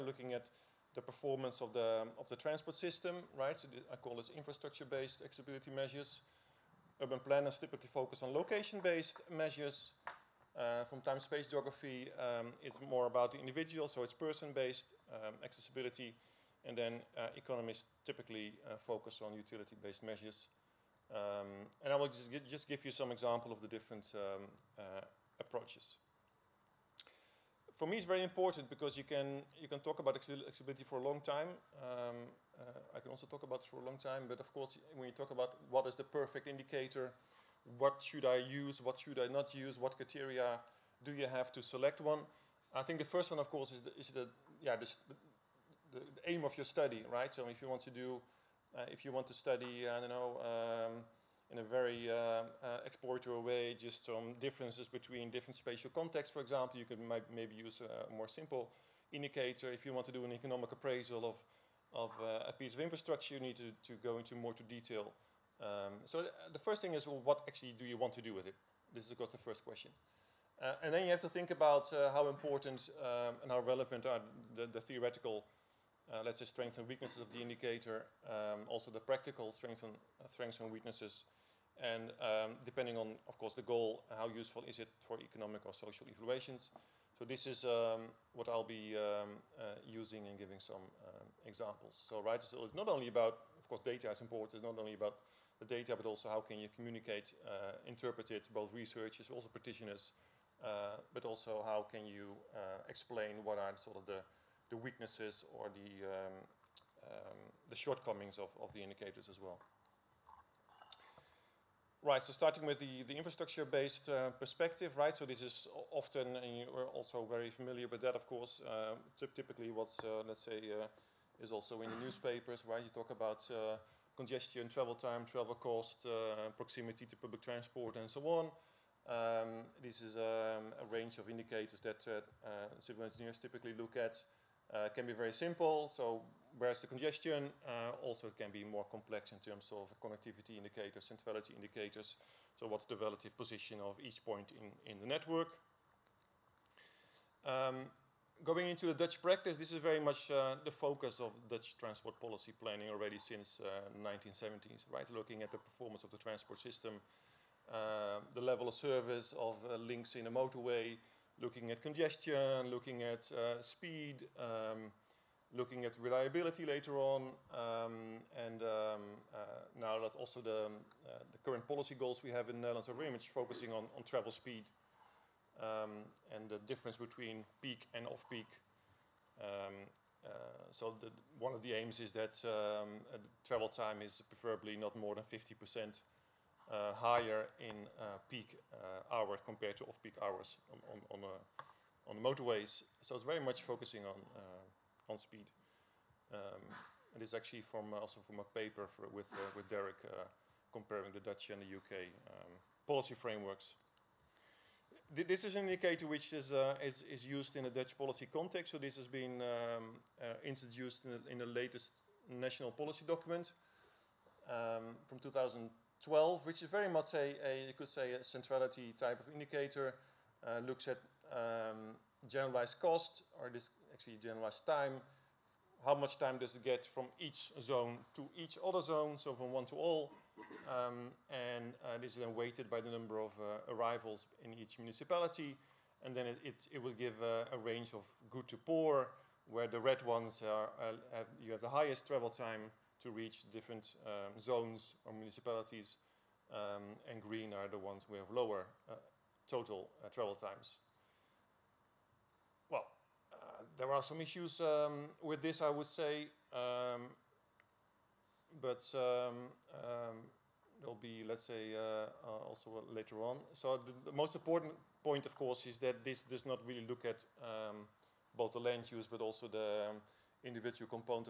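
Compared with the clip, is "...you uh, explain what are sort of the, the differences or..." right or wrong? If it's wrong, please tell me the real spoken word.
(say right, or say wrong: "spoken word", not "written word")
wrong: "weaknesses", not "differences".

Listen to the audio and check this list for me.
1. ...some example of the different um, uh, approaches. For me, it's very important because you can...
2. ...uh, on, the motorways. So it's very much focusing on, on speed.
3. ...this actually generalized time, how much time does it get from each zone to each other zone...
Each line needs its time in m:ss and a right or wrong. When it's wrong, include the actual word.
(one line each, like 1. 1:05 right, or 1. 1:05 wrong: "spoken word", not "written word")
1. 0:22 right
2. 3:11 right
3. 3:43 right.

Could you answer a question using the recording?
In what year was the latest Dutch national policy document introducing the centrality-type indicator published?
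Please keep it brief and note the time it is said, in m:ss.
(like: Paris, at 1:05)
2012, at 3:35.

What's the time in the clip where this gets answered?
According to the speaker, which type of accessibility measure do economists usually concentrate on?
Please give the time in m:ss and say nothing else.
0:19.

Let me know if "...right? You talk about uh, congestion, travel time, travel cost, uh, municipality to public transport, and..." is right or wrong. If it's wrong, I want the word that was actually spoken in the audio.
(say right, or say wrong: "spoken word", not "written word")
wrong: "proximity", not "municipality".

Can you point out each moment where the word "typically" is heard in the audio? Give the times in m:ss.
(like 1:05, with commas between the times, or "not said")
0:07, 0:18, 1:59, 2:13.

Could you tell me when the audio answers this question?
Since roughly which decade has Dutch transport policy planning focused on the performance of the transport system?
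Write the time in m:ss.
2:33.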